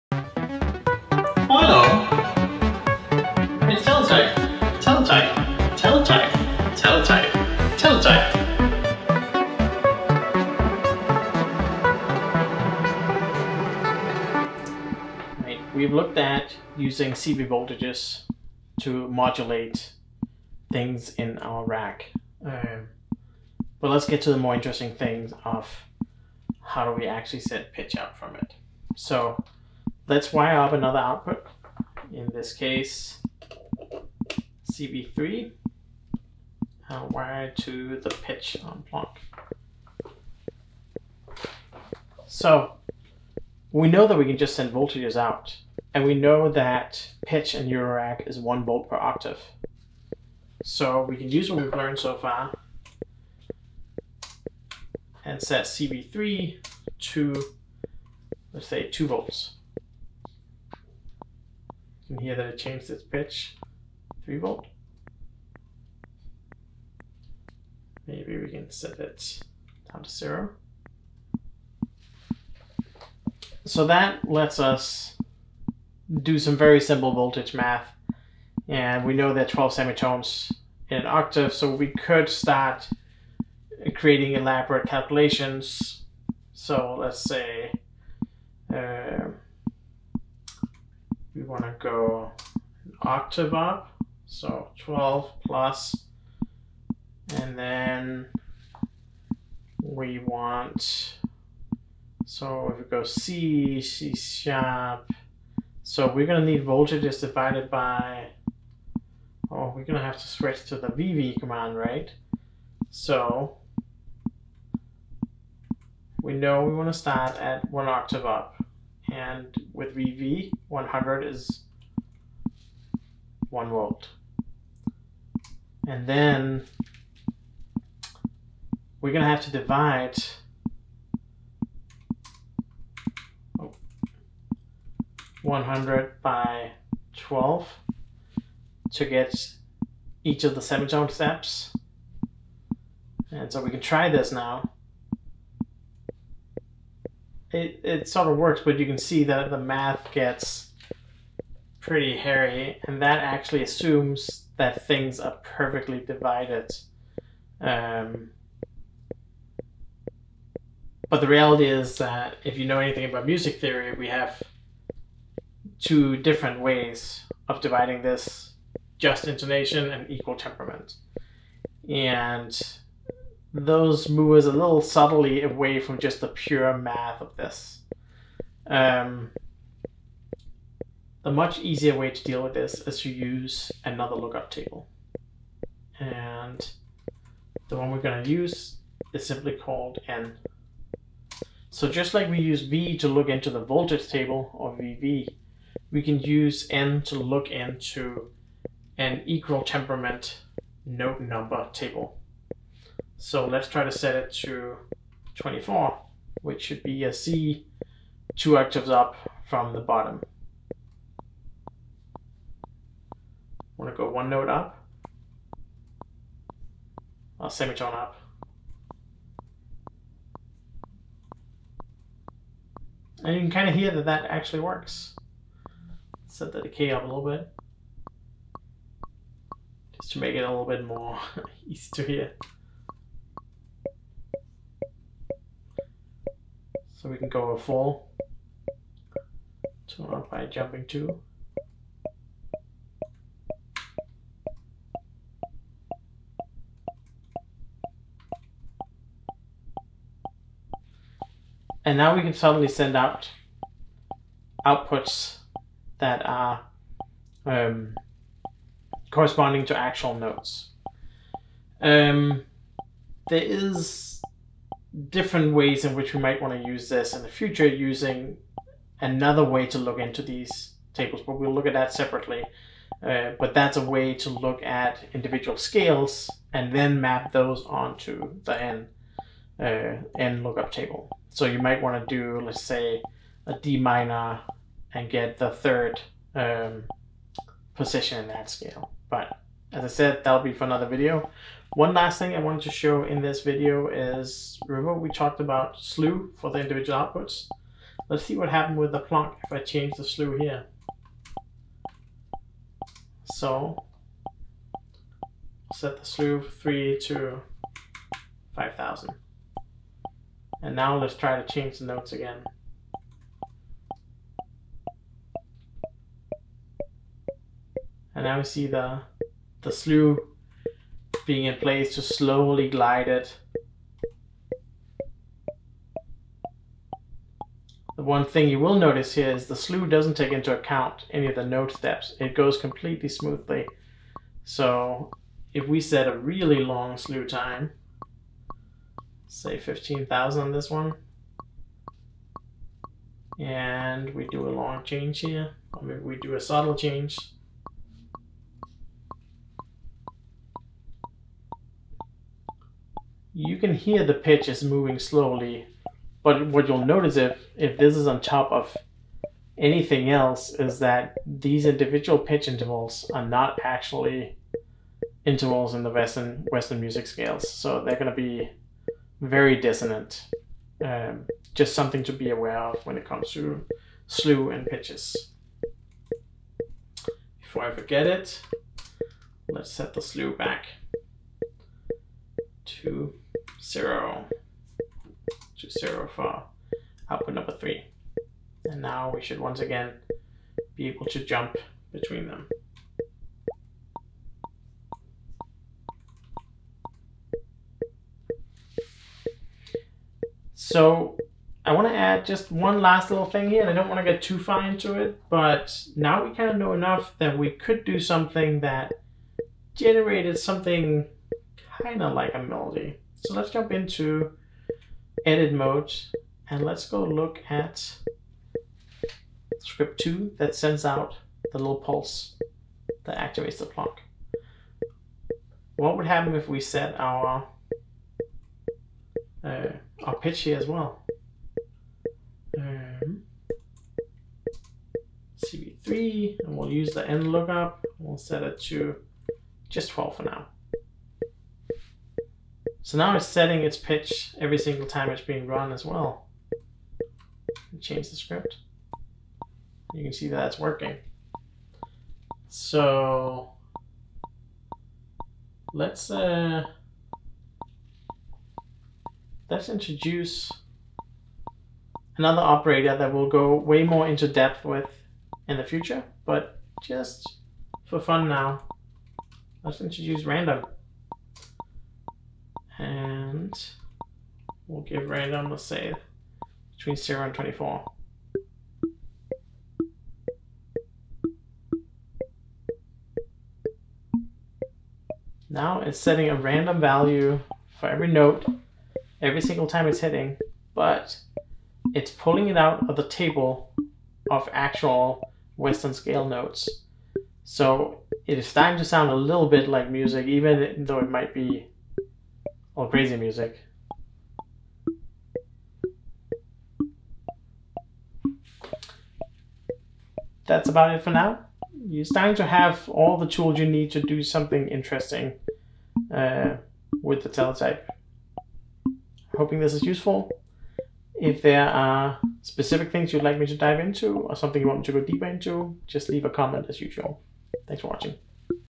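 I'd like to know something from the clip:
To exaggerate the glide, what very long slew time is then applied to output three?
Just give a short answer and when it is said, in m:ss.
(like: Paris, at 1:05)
15,000, at 5:39.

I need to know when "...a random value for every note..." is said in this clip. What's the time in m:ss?
8:06.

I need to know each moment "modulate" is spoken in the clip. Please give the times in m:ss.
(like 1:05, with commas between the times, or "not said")
0:19.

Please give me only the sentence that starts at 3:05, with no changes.
And the one we're going to use is simply called N.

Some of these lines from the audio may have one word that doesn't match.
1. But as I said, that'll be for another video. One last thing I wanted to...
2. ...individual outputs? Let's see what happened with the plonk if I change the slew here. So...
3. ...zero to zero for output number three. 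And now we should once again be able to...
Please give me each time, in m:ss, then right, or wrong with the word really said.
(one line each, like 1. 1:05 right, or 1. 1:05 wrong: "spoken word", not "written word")
1. 4:49 right
2. 4:56 right
3. 6:23 right.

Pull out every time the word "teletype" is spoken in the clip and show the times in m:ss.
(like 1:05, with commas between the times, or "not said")
8:37.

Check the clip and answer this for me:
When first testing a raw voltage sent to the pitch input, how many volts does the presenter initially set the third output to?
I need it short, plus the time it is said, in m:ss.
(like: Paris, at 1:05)
2 volts, at 0:58.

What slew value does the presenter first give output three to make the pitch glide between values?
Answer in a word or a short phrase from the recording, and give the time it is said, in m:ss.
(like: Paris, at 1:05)
5000, at 5:08.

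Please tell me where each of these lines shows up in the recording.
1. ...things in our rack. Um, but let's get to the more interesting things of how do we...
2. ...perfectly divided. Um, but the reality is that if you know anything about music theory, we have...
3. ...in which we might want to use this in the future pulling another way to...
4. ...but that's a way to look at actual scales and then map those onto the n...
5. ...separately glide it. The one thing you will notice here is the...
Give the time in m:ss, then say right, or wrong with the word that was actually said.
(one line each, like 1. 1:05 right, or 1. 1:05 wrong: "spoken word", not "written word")
1. 0:20 right
2. 2:35 right
3. 4:25 wrong: "using", not "pulling"
4. 4:33 wrong: "individual", not "actual"
5. 5:22 wrong: "slowly", not "separately".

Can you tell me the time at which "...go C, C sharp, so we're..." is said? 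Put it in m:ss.
1:42.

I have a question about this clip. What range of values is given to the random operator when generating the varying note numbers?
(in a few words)
Between 0 and 24.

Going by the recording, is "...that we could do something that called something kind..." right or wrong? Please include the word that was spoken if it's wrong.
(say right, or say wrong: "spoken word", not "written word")
wrong: "generated", not "called".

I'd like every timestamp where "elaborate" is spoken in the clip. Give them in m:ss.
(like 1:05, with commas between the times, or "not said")
1:24.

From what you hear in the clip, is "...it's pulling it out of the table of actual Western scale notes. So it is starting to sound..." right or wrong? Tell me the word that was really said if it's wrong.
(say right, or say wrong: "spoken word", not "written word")
right.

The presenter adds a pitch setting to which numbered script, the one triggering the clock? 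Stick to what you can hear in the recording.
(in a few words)
Script 2.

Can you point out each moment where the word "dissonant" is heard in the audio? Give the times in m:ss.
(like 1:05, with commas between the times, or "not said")
6:09.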